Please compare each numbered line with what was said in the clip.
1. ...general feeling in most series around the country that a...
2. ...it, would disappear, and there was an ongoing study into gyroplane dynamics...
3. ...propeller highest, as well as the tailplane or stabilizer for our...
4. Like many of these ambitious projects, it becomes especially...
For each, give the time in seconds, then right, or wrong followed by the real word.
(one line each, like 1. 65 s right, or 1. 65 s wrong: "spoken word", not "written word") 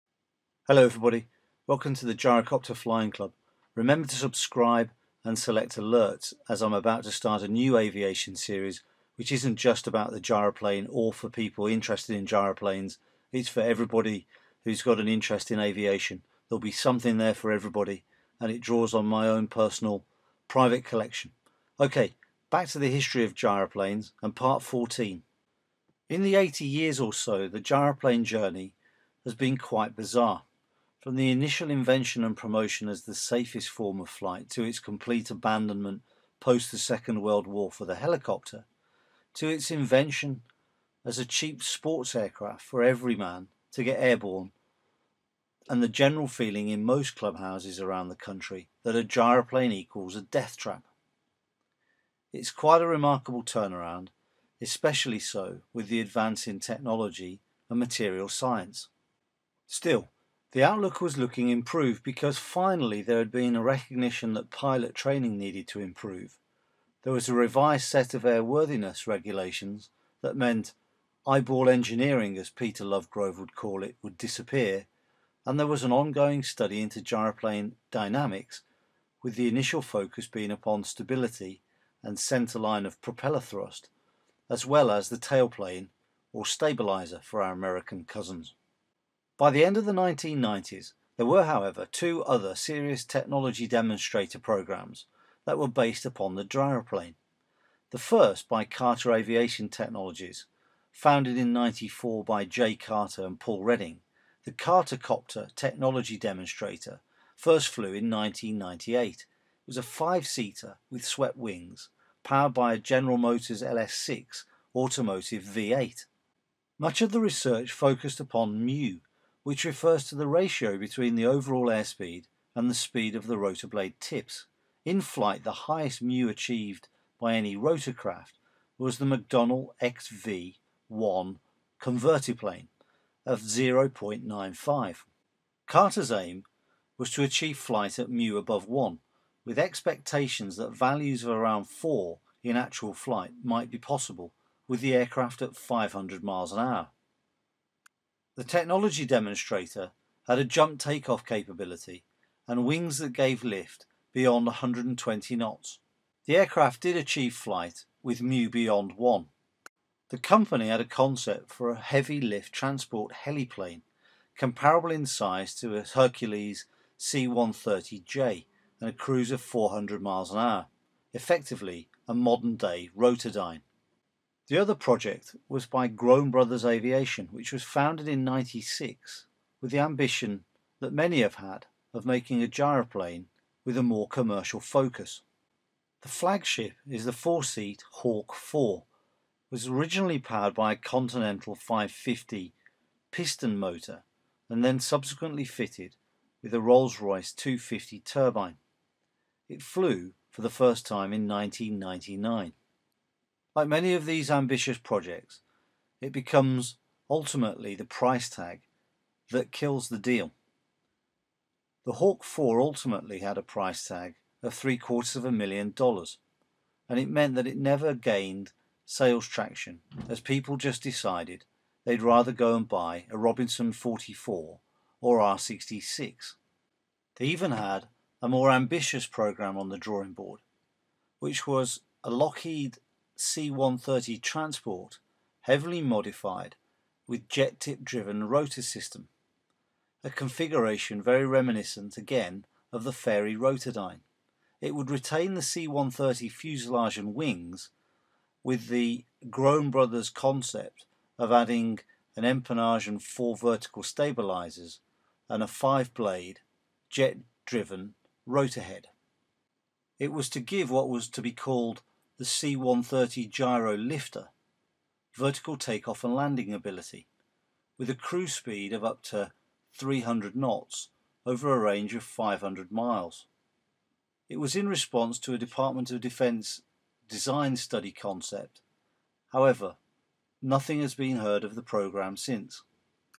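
1. 45 s wrong: "clubhouses", not "series"
2. 73 s right
3. 83 s wrong: "thrust", not "highest"
4. 203 s wrong: "ultimately", not "especially".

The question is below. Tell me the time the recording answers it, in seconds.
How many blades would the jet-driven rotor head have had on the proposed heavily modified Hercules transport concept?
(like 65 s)
255 s.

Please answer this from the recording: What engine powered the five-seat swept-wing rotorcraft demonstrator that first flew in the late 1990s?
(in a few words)
General Motors LS6.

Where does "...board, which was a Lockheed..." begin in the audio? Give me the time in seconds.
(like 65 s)
230 s.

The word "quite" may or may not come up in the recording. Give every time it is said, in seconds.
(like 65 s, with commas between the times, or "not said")
29 s, 52 s.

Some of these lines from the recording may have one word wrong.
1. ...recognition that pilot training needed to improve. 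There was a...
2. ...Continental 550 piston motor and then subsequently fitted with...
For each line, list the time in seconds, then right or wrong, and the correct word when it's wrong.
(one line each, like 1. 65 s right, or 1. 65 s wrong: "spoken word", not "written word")
1. 63 s right
2. 190 s right.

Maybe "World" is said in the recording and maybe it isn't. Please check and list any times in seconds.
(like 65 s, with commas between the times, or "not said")
37 s.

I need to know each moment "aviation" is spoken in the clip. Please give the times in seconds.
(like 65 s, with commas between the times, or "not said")
7 s, 15 s, 99 s, 176 s.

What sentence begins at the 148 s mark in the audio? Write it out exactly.
The technology demonstrator had a jump takeoff capability and wings that gave lift beyond 120 knots.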